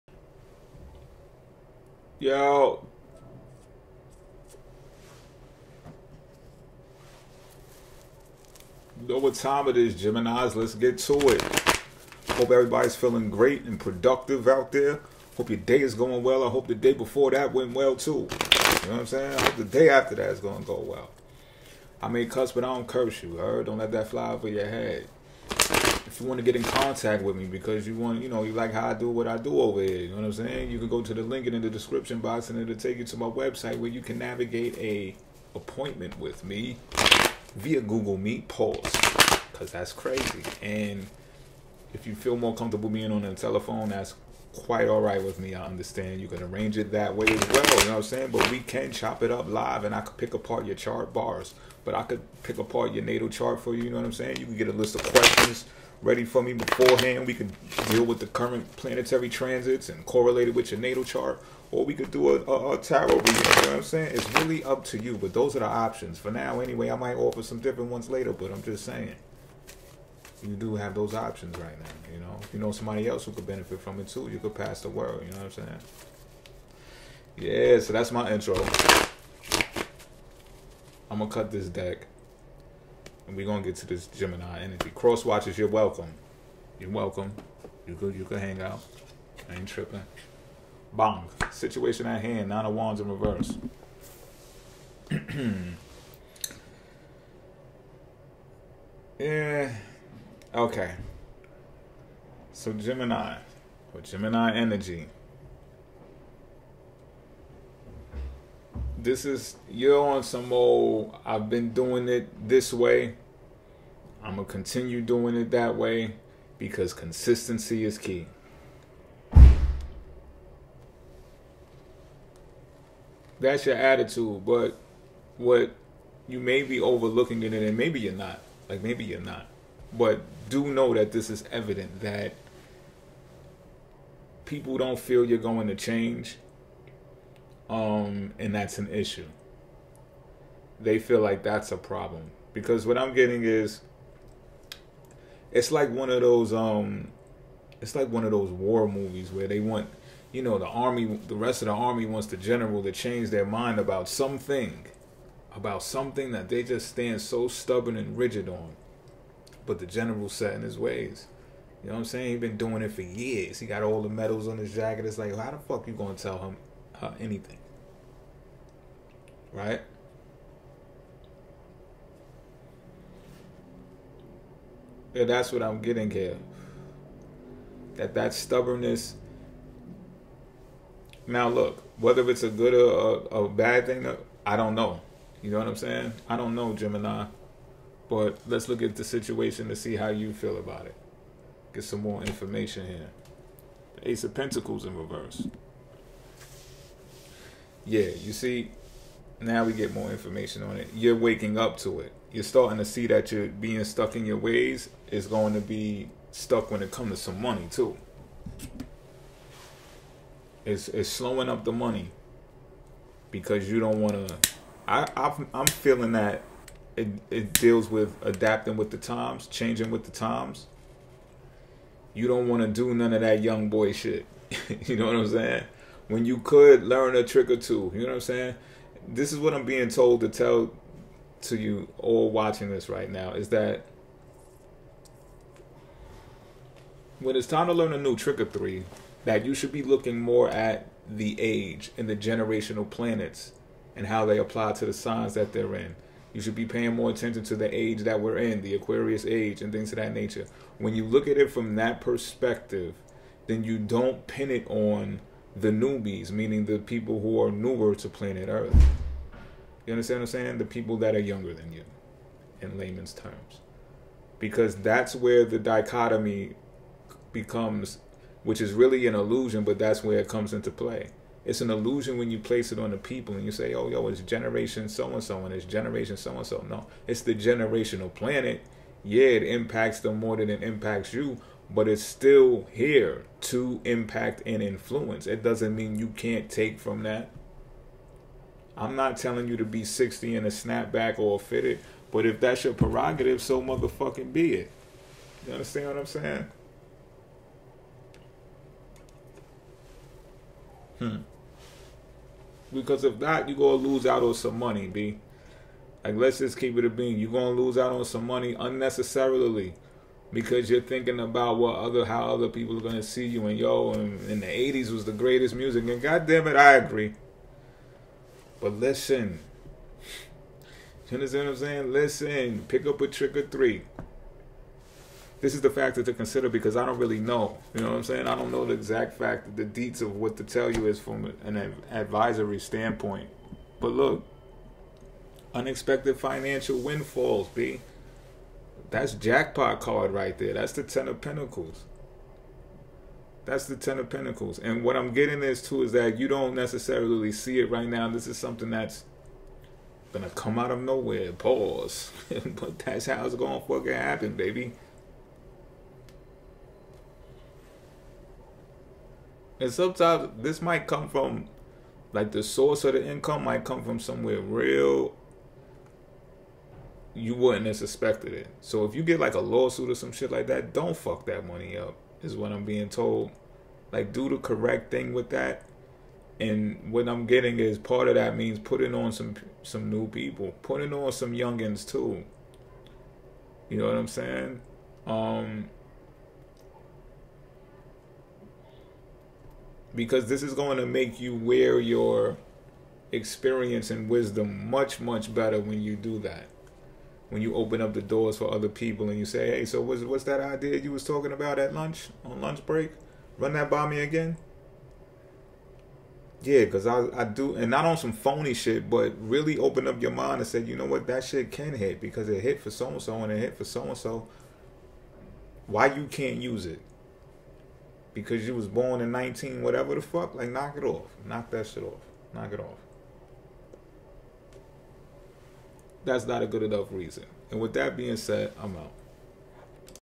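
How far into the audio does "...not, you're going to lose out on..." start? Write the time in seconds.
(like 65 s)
303 s.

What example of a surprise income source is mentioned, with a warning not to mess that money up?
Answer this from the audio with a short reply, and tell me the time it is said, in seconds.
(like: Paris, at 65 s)
a lawsuit, at 369 s.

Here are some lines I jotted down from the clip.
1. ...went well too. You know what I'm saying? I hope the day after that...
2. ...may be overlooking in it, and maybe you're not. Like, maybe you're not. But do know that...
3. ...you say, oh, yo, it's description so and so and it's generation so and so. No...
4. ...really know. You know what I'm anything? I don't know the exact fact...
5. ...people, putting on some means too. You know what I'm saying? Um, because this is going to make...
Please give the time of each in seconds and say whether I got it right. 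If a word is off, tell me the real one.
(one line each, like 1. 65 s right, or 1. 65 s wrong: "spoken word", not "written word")
1. 17 s right
2. 126 s right
3. 273 s wrong: "generation", not "description"
4. 326 s wrong: "saying", not "anything"
5. 380 s wrong: "youngins", not "means".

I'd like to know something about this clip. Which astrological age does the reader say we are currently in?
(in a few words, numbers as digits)
Aquarius age.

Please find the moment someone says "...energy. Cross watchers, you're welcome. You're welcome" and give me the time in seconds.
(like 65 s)
84 s.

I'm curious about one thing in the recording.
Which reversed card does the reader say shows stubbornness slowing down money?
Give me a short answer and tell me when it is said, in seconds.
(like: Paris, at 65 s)
Ace of Pentacles, at 193 s.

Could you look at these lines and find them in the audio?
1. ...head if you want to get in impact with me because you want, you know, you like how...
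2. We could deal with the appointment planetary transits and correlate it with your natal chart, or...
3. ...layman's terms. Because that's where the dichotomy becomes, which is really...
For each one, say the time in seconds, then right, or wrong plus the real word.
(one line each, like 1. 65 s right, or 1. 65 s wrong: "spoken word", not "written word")
1. 24 s wrong: "contact", not "impact"
2. 57 s wrong: "current", not "appointment"
3. 262 s right.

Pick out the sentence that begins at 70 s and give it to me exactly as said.
You do have those options right now, you know.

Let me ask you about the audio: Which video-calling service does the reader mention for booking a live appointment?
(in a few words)
Google Meet.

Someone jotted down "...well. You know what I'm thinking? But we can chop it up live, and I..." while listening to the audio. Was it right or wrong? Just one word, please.
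wrong.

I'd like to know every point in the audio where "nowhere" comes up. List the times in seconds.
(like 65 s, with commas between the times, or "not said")
350 s.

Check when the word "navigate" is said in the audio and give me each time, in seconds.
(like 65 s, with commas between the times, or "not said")
34 s.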